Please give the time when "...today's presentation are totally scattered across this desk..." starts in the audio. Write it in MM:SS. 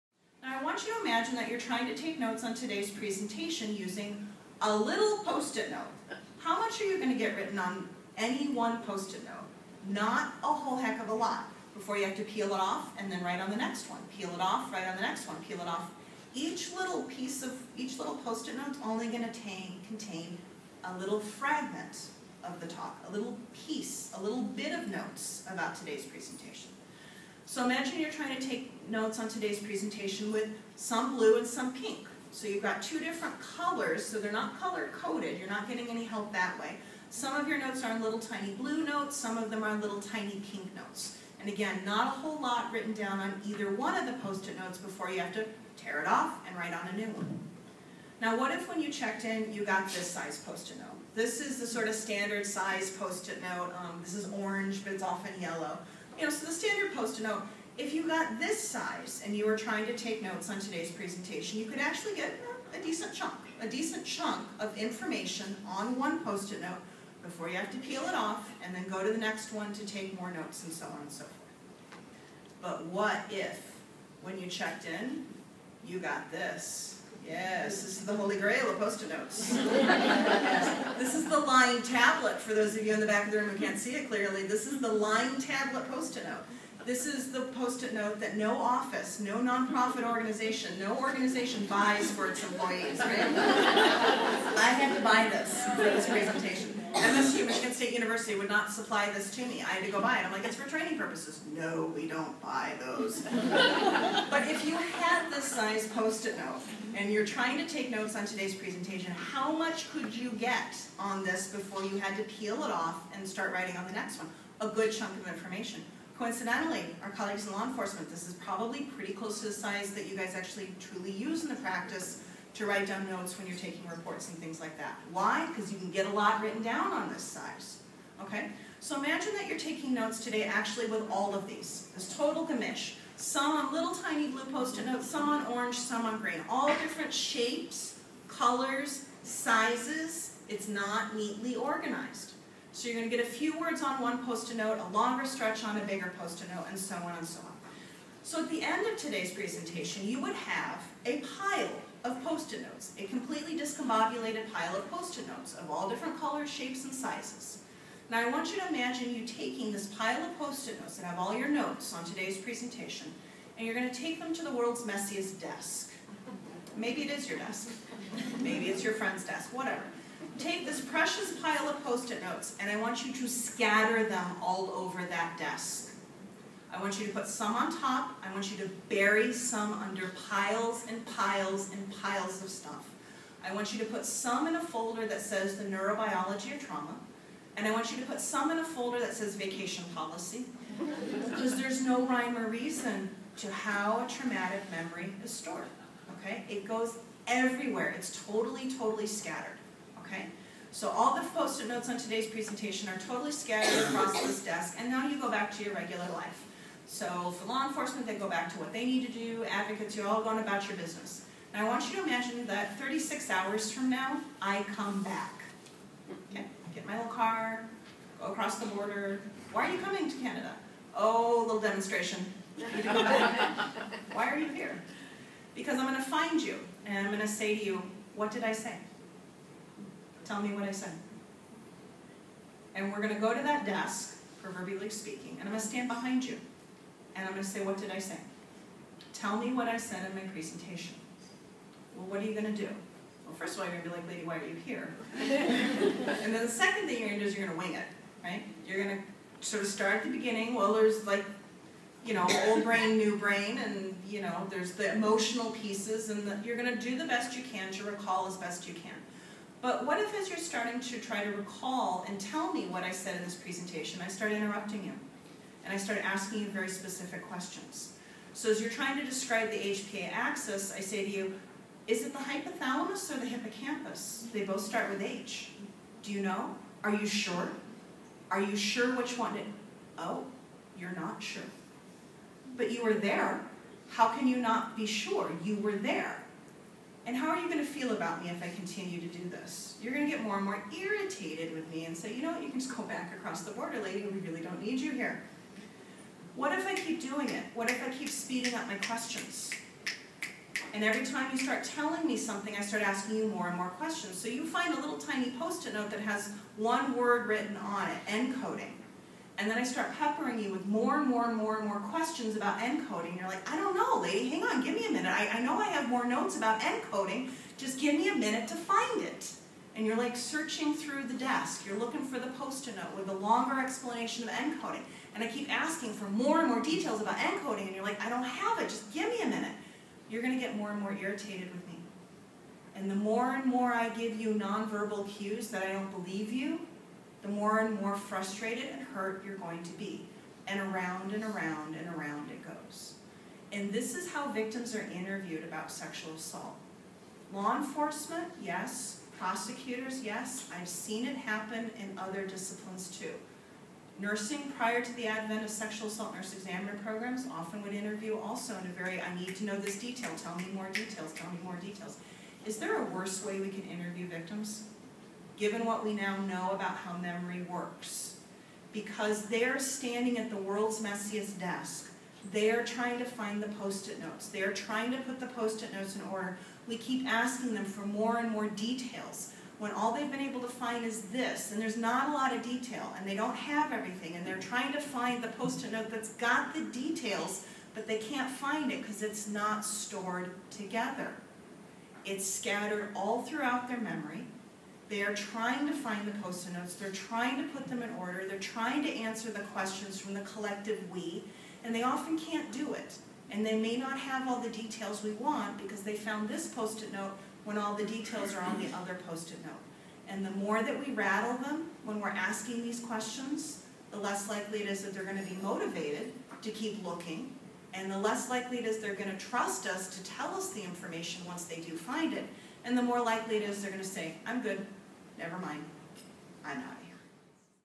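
03:21.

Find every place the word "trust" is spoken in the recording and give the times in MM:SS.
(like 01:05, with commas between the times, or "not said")
06:59.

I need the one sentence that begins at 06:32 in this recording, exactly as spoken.
It's scattered all throughout their memory.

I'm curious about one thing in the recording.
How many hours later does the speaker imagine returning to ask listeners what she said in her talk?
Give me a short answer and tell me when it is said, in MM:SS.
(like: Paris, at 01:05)
36, at 03:32.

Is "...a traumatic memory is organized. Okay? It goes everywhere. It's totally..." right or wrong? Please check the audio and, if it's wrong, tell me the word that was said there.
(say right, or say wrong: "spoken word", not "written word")
wrong: "stored", not "organized".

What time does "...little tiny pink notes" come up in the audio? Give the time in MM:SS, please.
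00:39.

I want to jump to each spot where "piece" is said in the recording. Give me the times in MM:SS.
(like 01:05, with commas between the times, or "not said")
00:17, 00:23, 04:15.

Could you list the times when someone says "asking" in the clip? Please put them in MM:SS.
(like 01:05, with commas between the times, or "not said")
04:26, 05:02, 05:25, 06:17, 06:52.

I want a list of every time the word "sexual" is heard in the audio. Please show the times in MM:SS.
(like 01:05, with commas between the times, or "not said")
05:45, 05:55.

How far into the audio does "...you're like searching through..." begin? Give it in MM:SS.
05:19.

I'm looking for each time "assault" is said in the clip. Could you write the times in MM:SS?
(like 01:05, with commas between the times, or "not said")
05:46, 05:55.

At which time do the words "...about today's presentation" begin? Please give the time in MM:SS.
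00:25.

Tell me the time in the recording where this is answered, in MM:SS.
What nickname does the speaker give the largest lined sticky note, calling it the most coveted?
01:18.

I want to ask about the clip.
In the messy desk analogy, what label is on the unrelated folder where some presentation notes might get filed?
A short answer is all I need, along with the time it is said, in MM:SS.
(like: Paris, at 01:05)
vacation policy, at 03:09.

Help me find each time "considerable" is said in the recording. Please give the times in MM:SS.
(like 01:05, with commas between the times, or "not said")
not said.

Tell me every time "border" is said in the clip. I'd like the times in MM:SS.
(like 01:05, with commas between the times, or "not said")
03:38, 04:53.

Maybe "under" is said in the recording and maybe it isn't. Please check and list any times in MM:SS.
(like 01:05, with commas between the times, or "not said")
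02:59.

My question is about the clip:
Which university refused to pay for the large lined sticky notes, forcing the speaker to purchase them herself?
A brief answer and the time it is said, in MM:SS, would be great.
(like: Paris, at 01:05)
Michigan State University, at 01:37.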